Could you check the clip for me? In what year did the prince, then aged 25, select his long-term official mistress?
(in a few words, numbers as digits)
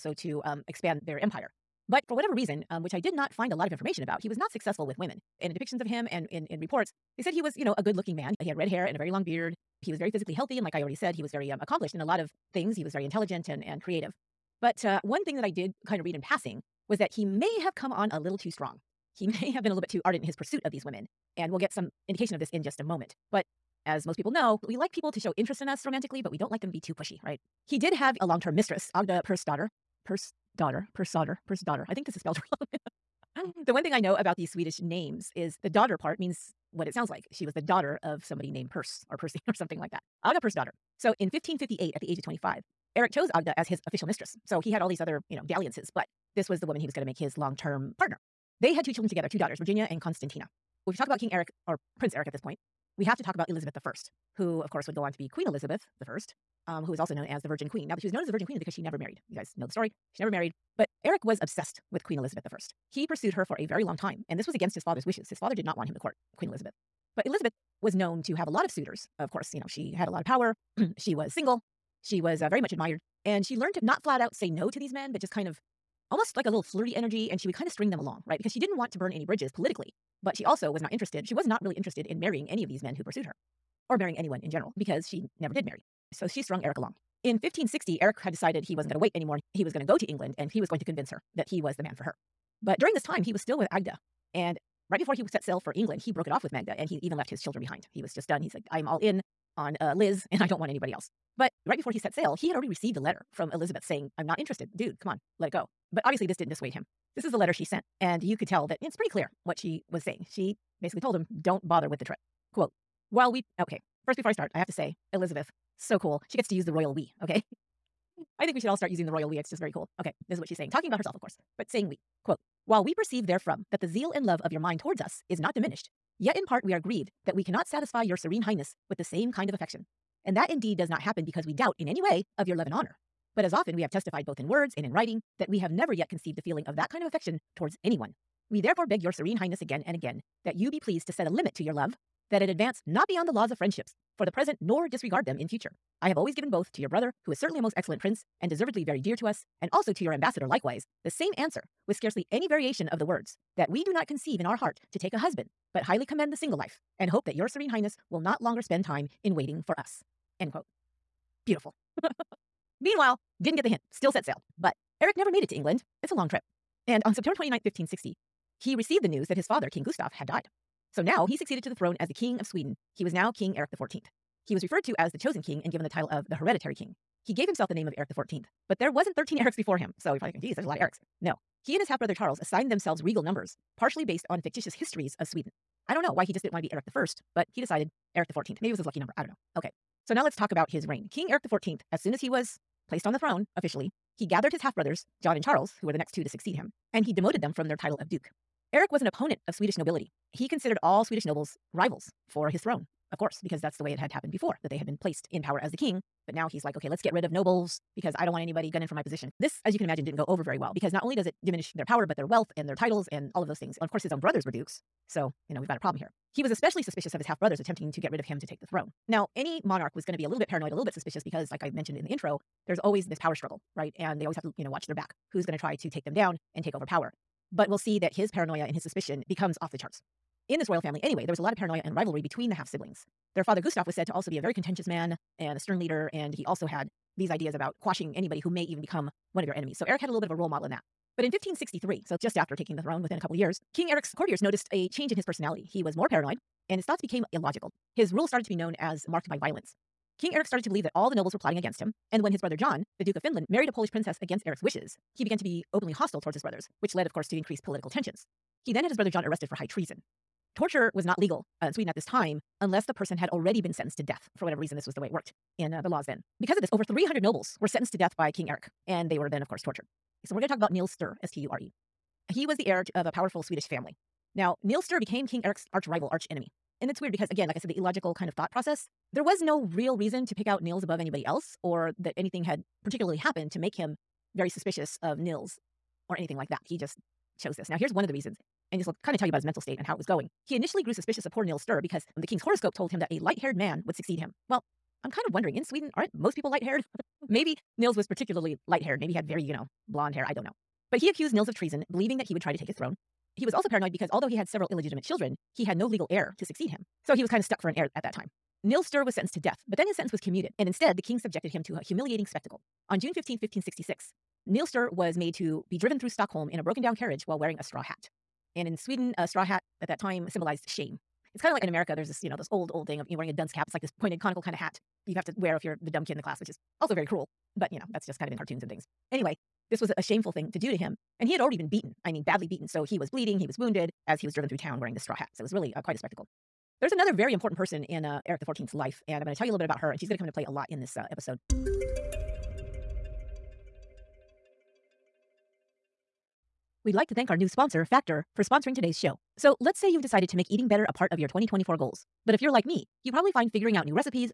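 1558.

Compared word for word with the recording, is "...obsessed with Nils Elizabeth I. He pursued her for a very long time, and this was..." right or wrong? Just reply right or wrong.
wrong.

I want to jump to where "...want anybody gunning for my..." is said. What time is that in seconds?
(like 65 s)
208 s.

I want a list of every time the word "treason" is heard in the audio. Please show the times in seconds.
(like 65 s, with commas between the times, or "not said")
259 s, 301 s.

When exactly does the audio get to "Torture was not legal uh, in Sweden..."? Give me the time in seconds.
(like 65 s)
260 s.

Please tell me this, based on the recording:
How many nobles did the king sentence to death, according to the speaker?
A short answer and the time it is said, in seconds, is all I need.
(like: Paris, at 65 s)
over 300, at 266 s.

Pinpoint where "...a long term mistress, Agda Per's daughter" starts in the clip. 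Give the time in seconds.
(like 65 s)
28 s.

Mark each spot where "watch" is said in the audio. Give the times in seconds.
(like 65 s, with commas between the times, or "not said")
224 s.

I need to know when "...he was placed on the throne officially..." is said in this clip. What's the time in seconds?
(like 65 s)
192 s.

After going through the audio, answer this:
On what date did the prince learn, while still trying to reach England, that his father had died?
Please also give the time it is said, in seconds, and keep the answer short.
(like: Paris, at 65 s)
September 29, 1560, at 167 s.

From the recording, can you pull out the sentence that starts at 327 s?
But, you know, that's just kind of in cartoons and things.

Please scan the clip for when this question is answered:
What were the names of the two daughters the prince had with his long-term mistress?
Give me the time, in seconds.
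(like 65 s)
49 s.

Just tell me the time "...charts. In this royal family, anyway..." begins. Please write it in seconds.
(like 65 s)
229 s.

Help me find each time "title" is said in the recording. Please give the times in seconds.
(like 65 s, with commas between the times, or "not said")
175 s, 197 s, 212 s.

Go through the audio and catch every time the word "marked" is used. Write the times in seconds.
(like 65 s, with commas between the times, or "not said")
249 s.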